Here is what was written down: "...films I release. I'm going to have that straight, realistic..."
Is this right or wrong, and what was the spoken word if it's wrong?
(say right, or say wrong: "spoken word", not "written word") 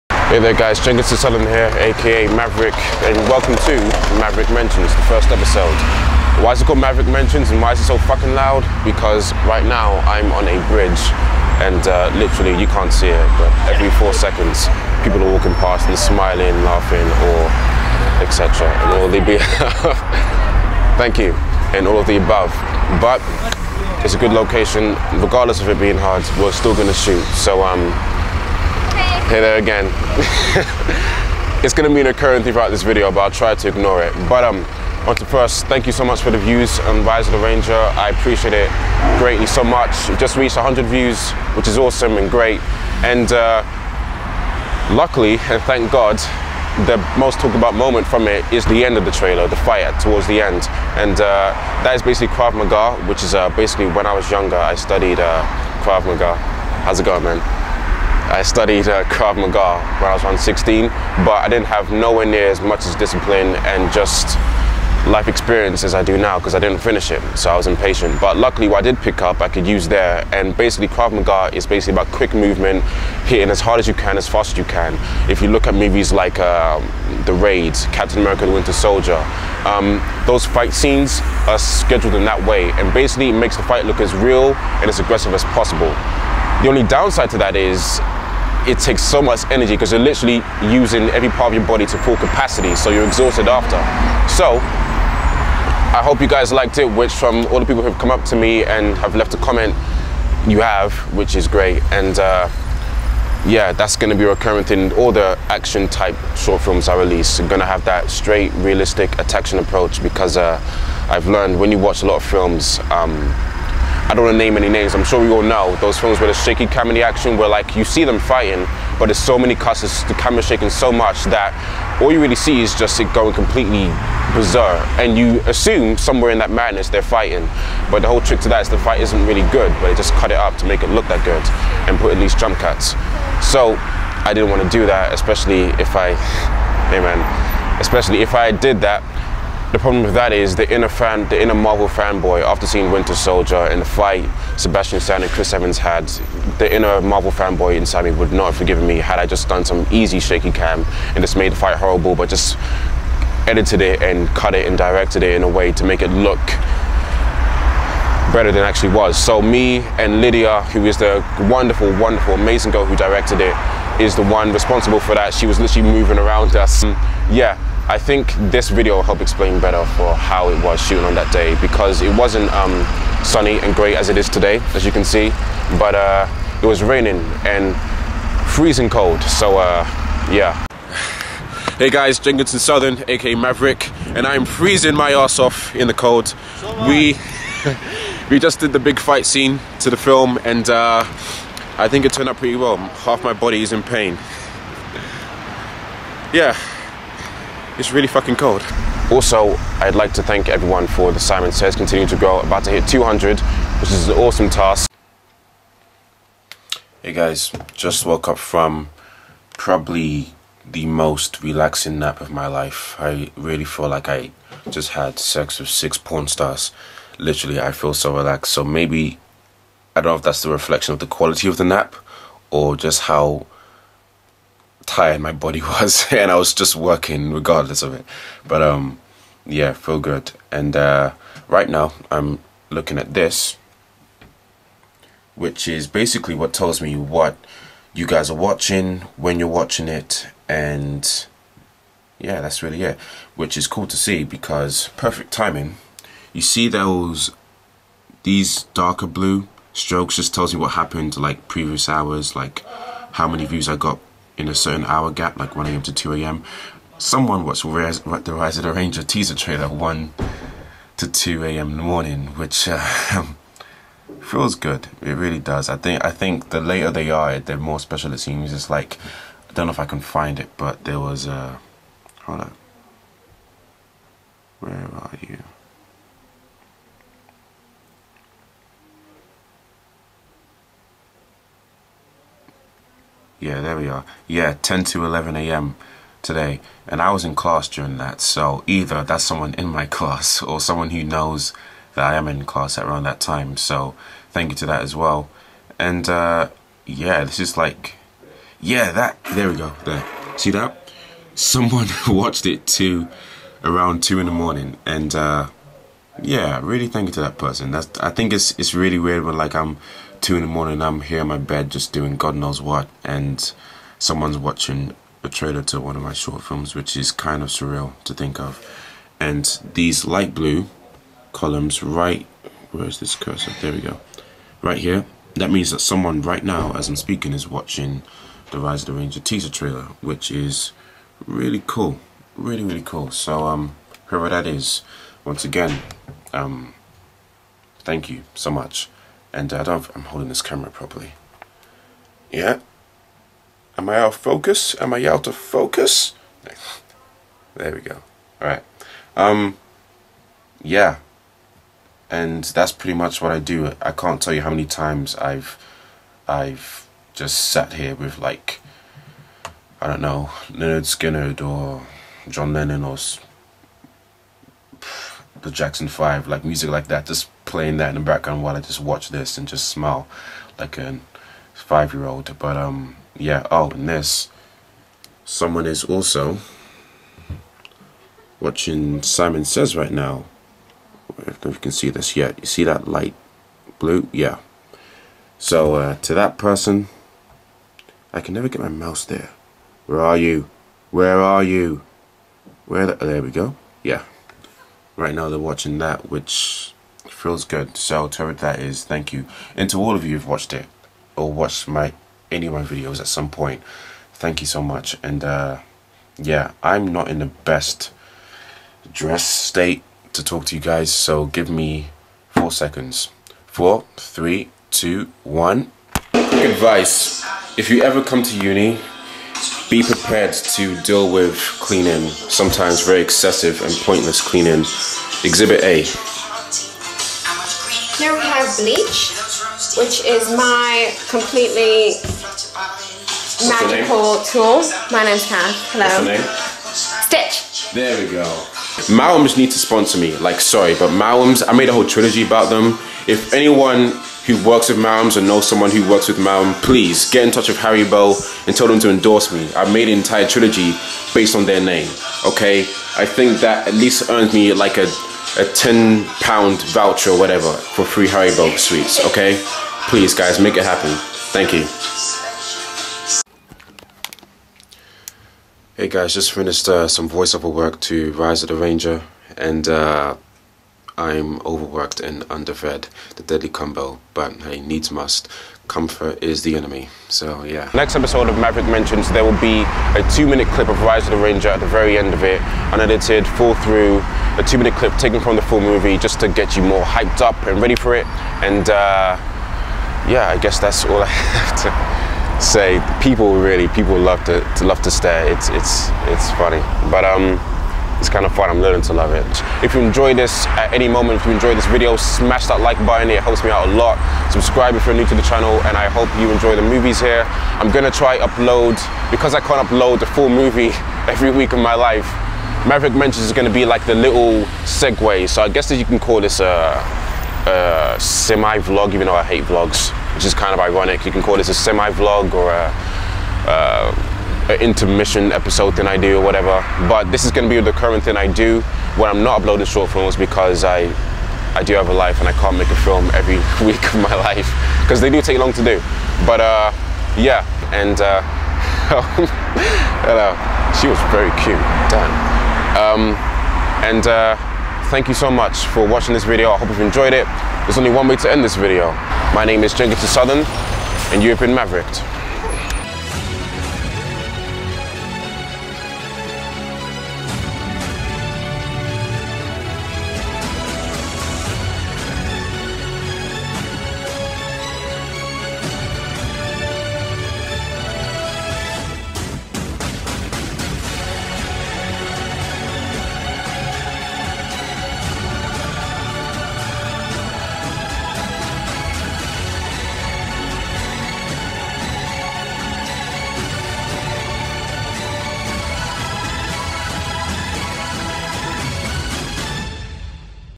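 right.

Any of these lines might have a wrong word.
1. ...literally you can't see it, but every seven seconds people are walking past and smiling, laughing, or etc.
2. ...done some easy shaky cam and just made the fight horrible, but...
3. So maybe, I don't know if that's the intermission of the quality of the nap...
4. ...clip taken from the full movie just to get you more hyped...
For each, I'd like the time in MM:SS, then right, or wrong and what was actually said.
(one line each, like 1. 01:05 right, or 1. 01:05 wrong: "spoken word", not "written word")
1. 00:12 wrong: "four", not "seven"
2. 02:29 right
3. 03:38 wrong: "reflection", not "intermission"
4. 08:04 right.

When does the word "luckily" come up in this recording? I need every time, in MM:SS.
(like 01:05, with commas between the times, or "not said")
00:44, 01:08.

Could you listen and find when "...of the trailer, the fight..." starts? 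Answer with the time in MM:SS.
00:48.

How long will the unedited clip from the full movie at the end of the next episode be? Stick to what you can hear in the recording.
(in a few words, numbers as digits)
2 minutes.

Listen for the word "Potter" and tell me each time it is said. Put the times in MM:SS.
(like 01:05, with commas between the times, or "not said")
07:38.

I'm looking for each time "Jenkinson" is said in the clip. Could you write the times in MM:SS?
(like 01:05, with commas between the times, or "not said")
00:00, 03:02, 09:09.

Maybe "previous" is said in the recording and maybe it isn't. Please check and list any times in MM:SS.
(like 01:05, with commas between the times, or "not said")
04:11.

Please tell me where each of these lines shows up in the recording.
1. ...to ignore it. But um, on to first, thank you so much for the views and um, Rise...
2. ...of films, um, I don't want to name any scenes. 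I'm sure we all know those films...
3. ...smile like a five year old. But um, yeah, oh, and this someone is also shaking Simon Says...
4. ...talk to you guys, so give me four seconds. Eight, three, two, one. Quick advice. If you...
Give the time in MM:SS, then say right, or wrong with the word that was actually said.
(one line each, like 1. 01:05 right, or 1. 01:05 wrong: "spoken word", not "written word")
1. 00:33 right
2. 01:52 wrong: "names", not "scenes"
3. 06:09 wrong: "watching", not "shaking"
4. 06:50 wrong: "Four", not "Eight".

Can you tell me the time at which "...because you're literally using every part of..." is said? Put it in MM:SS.
01:29.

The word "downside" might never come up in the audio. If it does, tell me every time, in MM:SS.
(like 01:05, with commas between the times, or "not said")
01:26.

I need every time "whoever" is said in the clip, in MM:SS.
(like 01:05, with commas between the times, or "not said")
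05:34, 06:38.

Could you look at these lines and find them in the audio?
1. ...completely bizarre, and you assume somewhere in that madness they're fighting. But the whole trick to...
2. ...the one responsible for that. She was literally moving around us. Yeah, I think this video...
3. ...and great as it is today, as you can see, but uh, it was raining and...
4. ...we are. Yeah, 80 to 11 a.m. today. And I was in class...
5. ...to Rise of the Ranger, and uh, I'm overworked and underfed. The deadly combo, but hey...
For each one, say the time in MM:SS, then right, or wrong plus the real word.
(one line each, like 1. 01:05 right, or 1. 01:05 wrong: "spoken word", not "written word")
1. 02:03 right
2. 02:44 right
3. 02:53 right
4. 04:43 wrong: "10", not "80"
5. 07:47 right.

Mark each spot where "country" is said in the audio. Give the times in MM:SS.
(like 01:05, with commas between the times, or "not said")
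not said.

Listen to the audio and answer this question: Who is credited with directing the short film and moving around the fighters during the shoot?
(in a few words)
Lydia.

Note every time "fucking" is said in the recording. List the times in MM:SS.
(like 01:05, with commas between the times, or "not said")
00:07, 03:18.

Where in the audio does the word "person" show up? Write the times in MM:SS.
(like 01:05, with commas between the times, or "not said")
05:07, 06:26.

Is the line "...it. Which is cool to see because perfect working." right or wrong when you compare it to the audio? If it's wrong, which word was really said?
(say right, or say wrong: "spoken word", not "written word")
wrong: "timing", not "working".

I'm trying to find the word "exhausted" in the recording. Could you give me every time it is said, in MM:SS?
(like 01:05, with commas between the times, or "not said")
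01:33.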